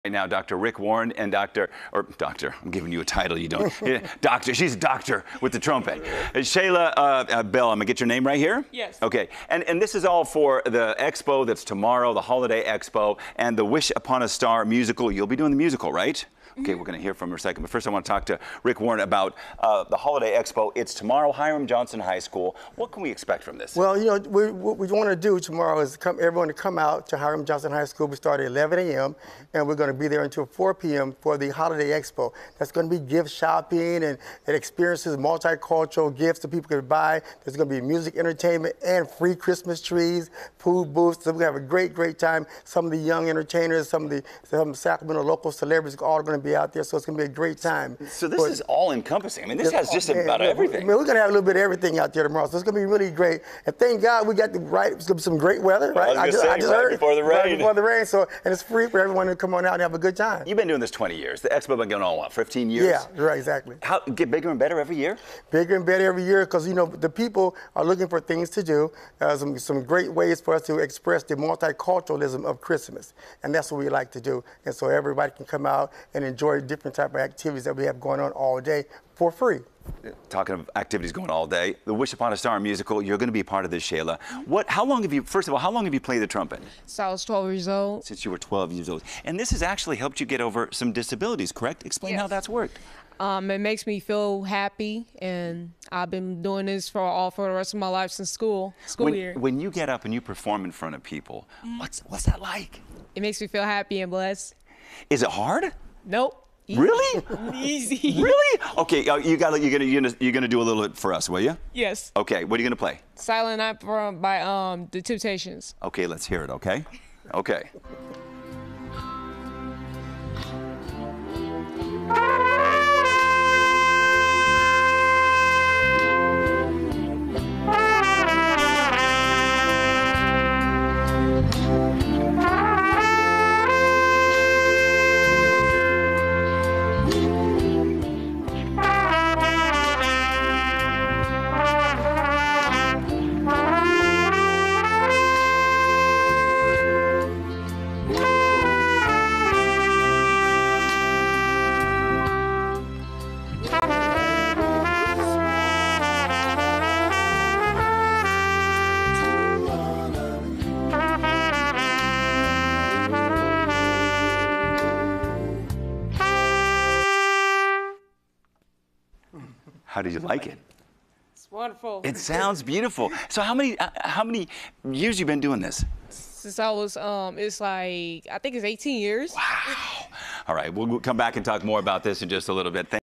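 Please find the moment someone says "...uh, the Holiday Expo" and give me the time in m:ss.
0:19.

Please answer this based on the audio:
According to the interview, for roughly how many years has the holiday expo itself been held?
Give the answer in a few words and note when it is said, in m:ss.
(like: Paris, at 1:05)
15 years, at 1:02.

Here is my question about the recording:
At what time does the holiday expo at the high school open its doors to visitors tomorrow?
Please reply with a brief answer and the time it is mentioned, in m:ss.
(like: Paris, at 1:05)
11 a.m., at 0:28.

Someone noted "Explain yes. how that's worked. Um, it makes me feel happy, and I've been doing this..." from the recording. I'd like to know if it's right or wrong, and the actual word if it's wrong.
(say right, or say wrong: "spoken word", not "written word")
right.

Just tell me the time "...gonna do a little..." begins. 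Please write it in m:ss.
1:50.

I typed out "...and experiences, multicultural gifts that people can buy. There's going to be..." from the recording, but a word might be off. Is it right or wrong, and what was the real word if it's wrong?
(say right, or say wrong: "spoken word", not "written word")
right.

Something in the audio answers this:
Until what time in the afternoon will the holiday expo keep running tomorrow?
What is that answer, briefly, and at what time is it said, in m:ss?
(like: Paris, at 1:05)
4 p.m., at 0:30.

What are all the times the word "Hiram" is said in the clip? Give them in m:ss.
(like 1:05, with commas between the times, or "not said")
0:21, 0:27.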